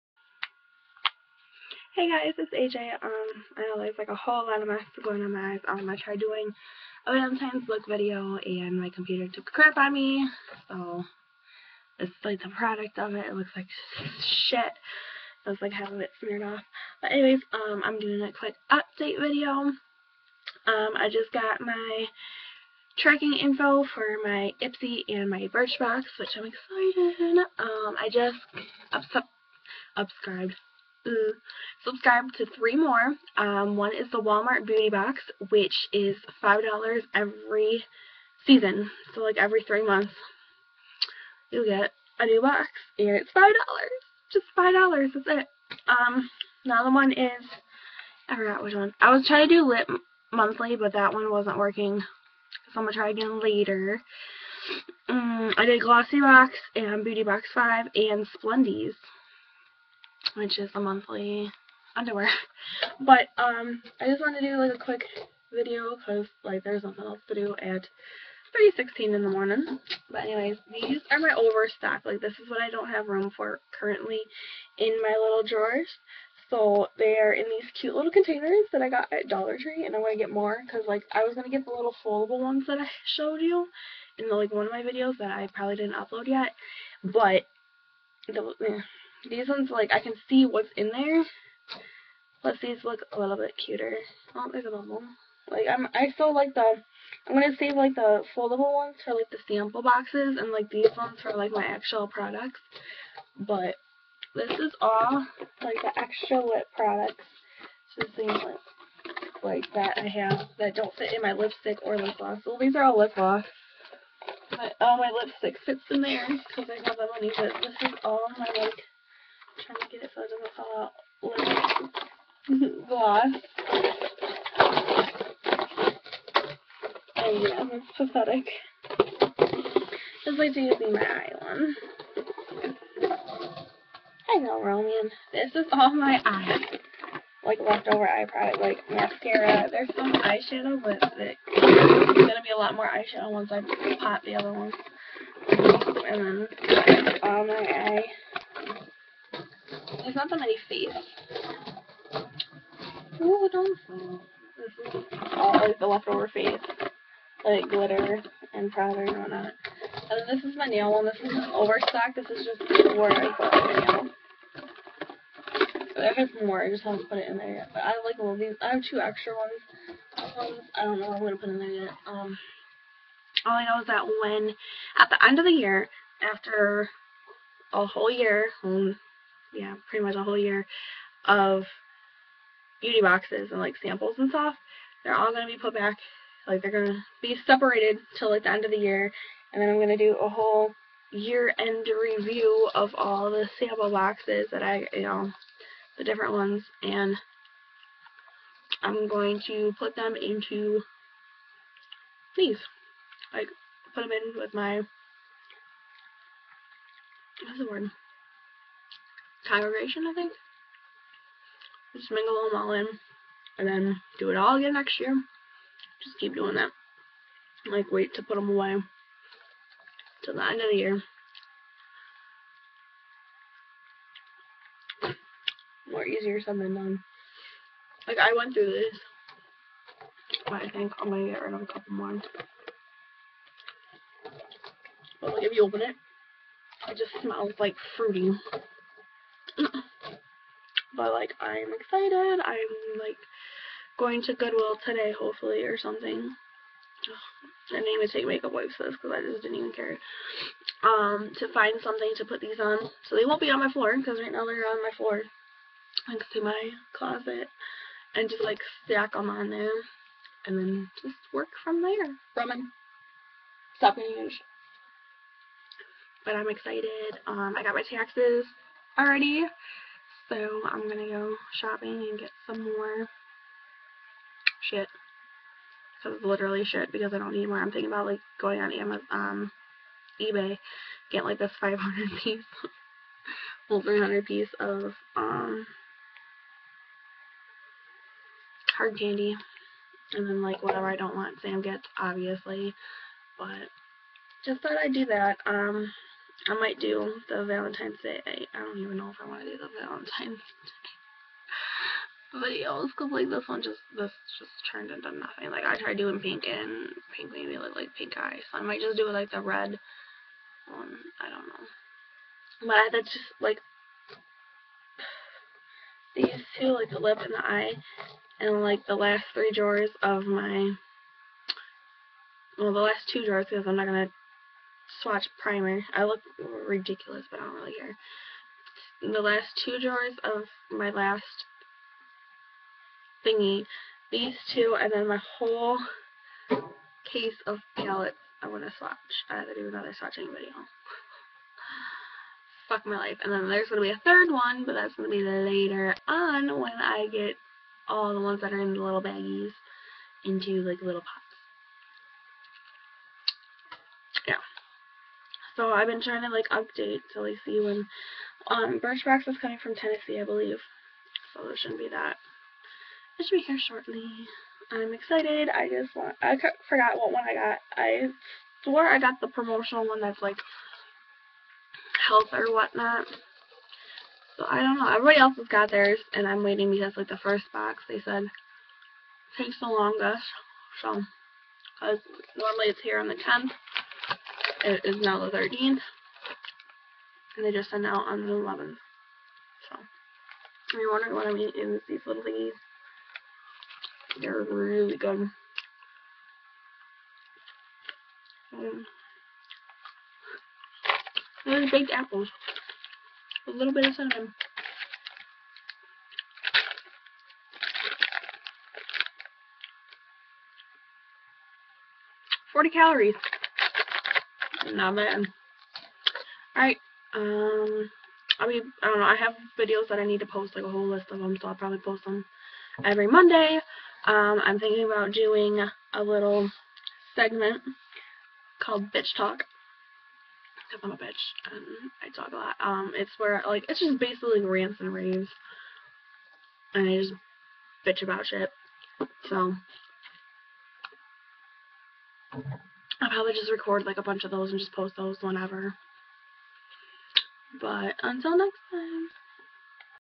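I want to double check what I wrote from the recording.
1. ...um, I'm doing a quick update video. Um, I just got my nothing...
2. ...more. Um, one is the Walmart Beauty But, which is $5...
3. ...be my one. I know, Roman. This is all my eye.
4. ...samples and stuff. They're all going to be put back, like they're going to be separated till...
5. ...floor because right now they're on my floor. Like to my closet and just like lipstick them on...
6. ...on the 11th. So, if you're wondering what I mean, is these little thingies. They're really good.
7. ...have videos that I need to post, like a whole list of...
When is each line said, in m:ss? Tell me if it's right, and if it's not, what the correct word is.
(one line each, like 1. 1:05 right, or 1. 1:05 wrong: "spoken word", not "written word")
1. 0:17 wrong: "tracking", not "nothing"
2. 0:32 wrong: "Box", not "But"
3. 2:10 right
4. 3:03 right
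5. 4:13 wrong: "stack", not "lipstick"
6. 6:28 right
7. 6:59 right.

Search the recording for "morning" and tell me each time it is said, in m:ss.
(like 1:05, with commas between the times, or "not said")
1:09.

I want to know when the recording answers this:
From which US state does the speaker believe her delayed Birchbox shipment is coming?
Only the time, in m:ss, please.
5:59.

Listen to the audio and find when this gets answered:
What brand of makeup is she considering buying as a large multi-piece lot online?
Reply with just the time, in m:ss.
4:48.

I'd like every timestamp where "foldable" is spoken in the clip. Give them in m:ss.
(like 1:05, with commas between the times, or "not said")
1:22, 1:38.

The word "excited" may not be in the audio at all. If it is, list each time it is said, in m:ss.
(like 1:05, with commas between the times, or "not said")
0:26, 4:01, 4:26, 6:04.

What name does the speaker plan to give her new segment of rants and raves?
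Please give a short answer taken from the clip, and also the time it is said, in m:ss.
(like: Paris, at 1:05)
Bitch Talk, at 7:08.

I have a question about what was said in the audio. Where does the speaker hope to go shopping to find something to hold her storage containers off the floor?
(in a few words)
Goodwill.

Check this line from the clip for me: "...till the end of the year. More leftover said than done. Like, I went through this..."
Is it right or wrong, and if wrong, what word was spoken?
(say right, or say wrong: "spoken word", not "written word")
wrong: "easier", not "leftover".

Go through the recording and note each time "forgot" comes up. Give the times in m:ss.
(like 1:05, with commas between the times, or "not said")
0:48, 6:06.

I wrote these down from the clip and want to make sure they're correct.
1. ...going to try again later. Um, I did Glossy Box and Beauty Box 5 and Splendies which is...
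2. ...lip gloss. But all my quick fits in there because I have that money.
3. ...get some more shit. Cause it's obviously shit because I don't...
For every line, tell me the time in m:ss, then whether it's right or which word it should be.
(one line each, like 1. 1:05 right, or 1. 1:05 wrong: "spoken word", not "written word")
1. 0:52 right
2. 1:52 wrong: "lipstick", not "quick"
3. 4:32 wrong: "literally", not "obviously".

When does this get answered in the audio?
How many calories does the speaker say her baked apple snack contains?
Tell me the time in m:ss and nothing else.
6:52.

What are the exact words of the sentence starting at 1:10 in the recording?
But anyways, these are my overstock.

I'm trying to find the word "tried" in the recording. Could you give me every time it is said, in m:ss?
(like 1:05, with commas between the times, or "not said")
0:05, 5:05.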